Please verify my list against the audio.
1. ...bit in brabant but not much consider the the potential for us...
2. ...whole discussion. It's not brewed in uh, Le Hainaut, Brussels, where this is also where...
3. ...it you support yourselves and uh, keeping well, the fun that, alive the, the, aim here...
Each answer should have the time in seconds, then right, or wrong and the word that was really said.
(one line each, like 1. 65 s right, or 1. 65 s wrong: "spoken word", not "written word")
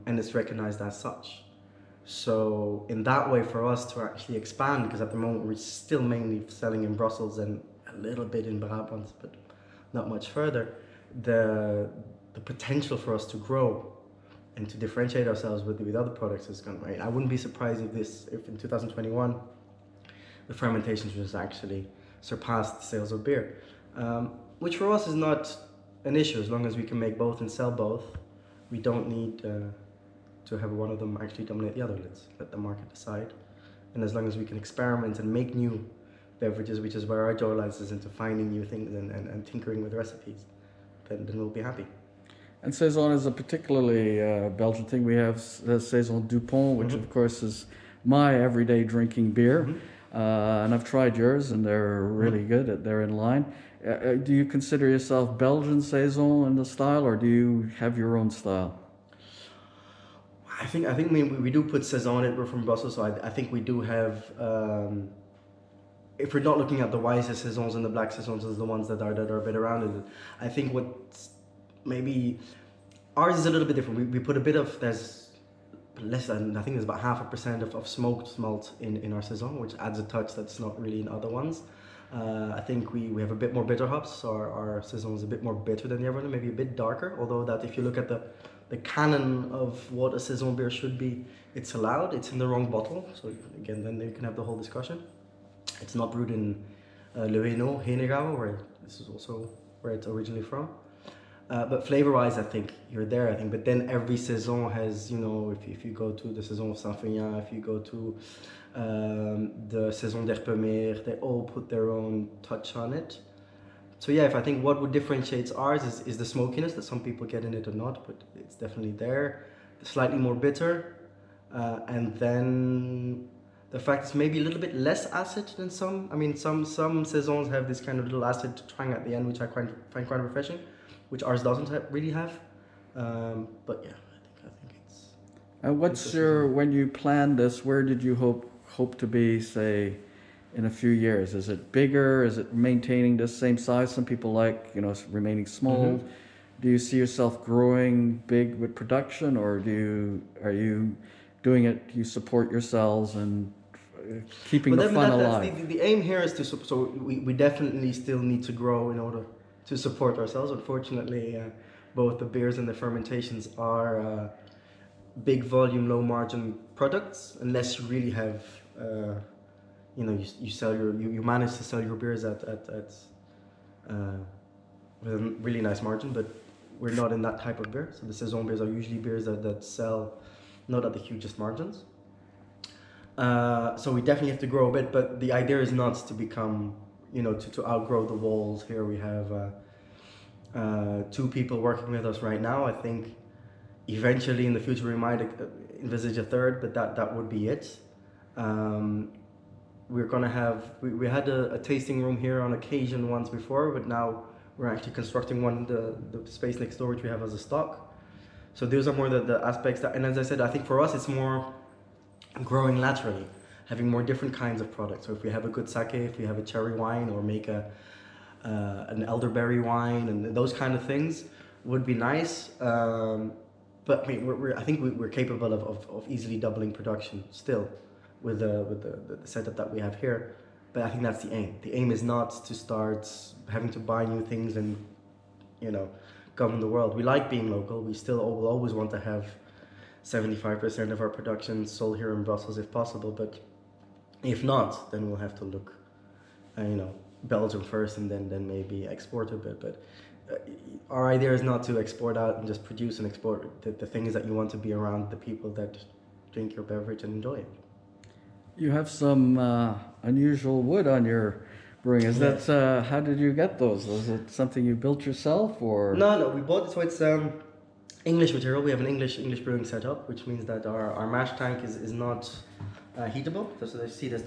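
1. 8 s wrong: "further", not "consider"
2. 94 s wrong: "Henegau", not "Brussels"
3. 151 s right.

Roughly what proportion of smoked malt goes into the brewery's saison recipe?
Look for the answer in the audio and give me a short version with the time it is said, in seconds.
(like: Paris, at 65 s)
half a percent, at 76 s.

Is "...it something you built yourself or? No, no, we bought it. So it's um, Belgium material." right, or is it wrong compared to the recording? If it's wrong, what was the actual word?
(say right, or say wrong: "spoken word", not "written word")
wrong: "English", not "Belgium".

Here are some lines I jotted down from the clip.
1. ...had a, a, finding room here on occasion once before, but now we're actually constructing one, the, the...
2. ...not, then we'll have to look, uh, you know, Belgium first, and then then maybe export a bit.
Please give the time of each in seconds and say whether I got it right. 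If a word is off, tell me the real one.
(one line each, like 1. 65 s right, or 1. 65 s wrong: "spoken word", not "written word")
1. 201 s wrong: "tasting", not "finding"
2. 244 s right.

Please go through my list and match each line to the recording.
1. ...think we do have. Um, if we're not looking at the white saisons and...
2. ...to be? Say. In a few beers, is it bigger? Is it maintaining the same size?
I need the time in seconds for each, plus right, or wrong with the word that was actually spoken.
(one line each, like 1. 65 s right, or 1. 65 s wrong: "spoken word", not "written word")
1. 63 s right
2. 138 s wrong: "years", not "beers".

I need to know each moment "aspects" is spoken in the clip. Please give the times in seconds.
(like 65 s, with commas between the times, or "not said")
209 s.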